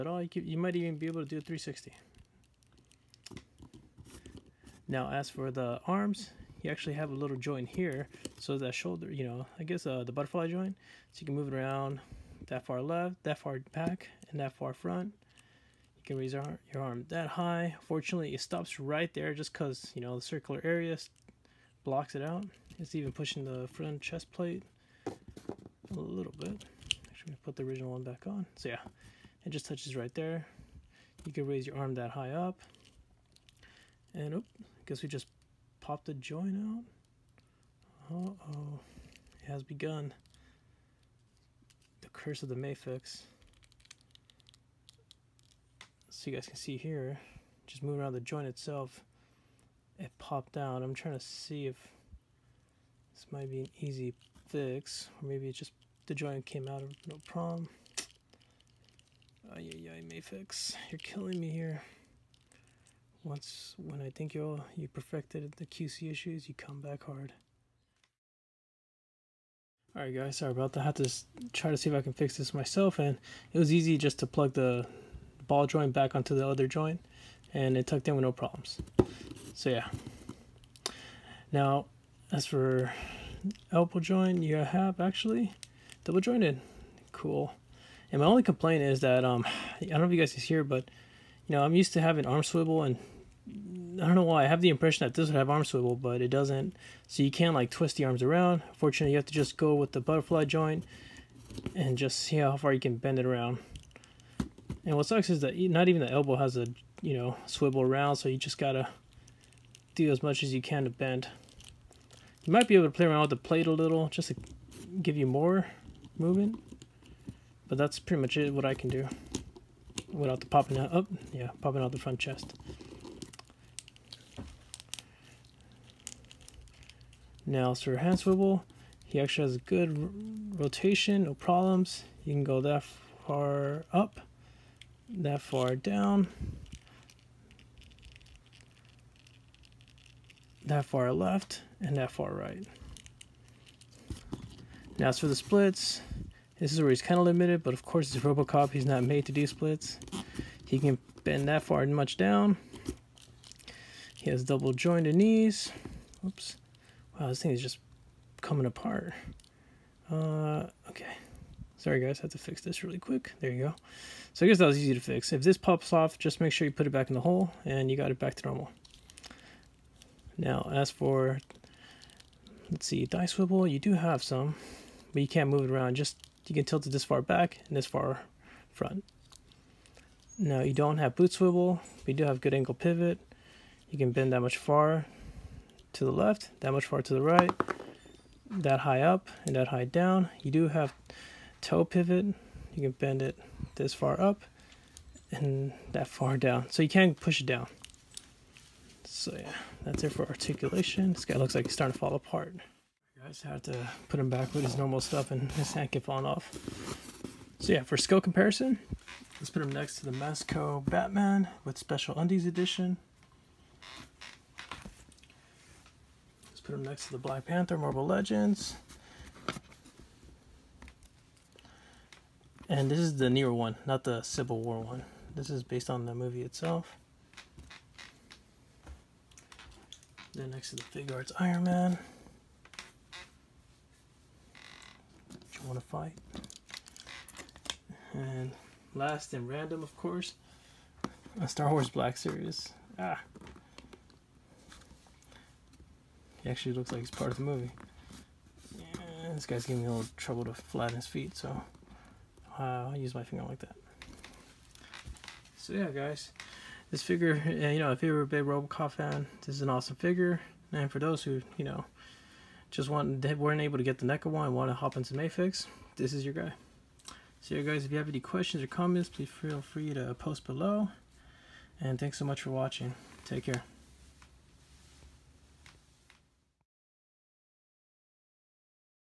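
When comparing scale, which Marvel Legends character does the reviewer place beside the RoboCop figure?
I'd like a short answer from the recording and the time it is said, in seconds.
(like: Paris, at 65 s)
Black Panther, at 217 s.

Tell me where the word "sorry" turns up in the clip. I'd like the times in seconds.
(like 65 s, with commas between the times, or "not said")
70 s, 161 s.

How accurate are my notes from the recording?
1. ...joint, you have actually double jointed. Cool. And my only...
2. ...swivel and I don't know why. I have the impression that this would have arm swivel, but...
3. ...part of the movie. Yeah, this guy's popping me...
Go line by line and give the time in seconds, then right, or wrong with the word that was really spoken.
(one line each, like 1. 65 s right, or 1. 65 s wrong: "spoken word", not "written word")
1. 83 s right
2. 92 s right
3. 247 s wrong: "giving", not "popping".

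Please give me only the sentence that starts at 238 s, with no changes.
And last and random, of course, a Star Wars Black Series.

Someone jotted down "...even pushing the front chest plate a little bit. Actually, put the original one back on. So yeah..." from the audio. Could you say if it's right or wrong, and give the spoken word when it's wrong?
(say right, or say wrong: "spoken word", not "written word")
right.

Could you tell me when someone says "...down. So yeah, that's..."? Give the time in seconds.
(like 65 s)
197 s.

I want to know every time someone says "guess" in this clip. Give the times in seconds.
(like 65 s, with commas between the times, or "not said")
9 s, 34 s, 164 s.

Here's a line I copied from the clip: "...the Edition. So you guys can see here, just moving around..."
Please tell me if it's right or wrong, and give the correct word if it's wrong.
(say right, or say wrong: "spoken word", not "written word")
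wrong: "Mafex", not "Edition".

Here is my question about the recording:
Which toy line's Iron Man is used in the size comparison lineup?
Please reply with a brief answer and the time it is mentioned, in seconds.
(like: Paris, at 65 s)
Figuarts, at 230 s.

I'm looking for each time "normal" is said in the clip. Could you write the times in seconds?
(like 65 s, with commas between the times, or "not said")
168 s, 204 s.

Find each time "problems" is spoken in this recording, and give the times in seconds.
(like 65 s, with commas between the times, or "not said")
57 s, 78 s, 131 s.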